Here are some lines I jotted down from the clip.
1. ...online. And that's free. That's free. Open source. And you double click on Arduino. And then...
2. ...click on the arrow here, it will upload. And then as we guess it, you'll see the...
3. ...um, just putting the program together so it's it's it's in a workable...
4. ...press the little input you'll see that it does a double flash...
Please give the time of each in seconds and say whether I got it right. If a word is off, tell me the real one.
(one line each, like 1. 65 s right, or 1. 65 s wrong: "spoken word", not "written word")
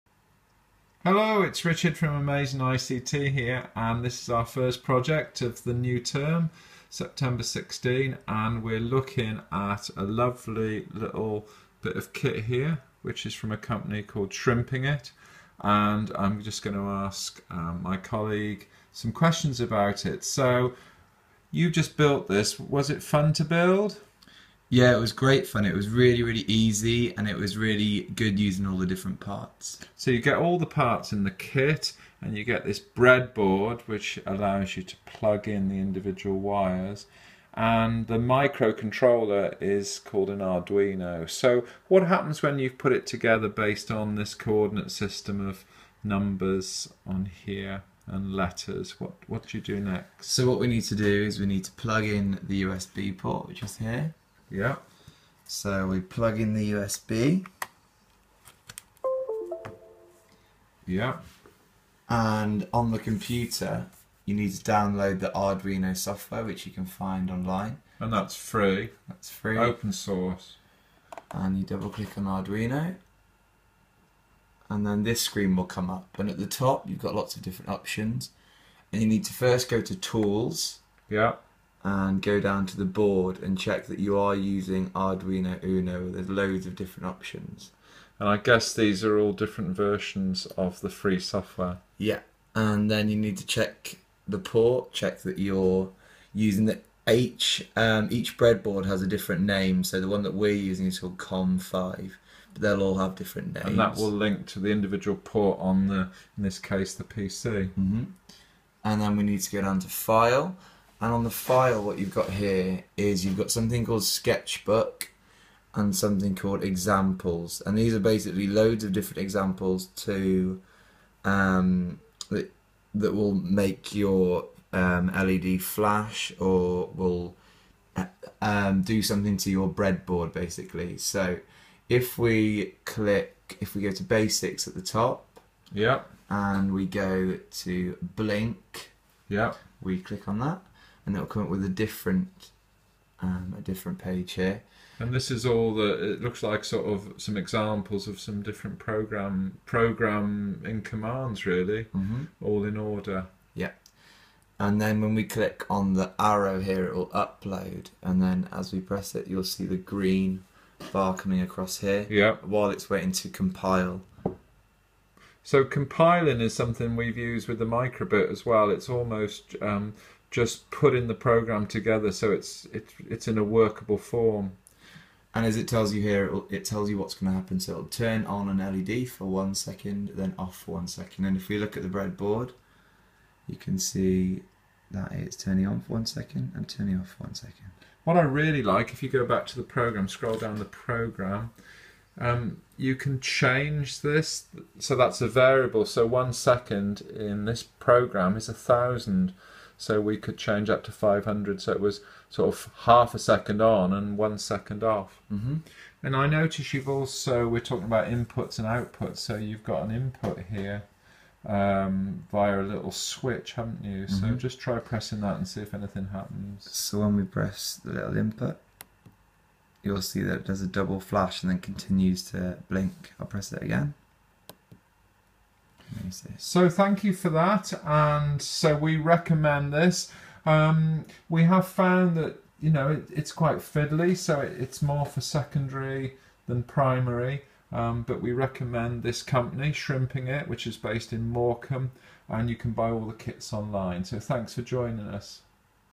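1. 67 s right
2. 155 s wrong: "press", not "guess"
3. 169 s right
4. 217 s right.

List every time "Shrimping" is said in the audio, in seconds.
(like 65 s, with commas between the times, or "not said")
14 s, 239 s.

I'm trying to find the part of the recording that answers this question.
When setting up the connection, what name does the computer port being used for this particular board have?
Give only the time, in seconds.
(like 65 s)
101 s.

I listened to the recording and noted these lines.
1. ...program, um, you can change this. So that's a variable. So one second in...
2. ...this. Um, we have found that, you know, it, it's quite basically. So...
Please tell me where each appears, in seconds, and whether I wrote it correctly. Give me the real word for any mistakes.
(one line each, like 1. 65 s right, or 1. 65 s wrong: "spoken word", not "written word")
1. 190 s right
2. 229 s wrong: "fiddly", not "basically".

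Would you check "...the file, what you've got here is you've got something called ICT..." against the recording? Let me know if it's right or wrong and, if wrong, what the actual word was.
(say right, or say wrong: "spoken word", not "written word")
wrong: "Sketchbook", not "ICT".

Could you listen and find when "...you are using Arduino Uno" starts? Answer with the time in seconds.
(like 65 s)
83 s.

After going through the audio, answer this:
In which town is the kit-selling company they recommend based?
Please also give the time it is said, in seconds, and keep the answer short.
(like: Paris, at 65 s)
Morecambe, at 241 s.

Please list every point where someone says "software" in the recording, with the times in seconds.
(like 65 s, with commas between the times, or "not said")
65 s, 91 s.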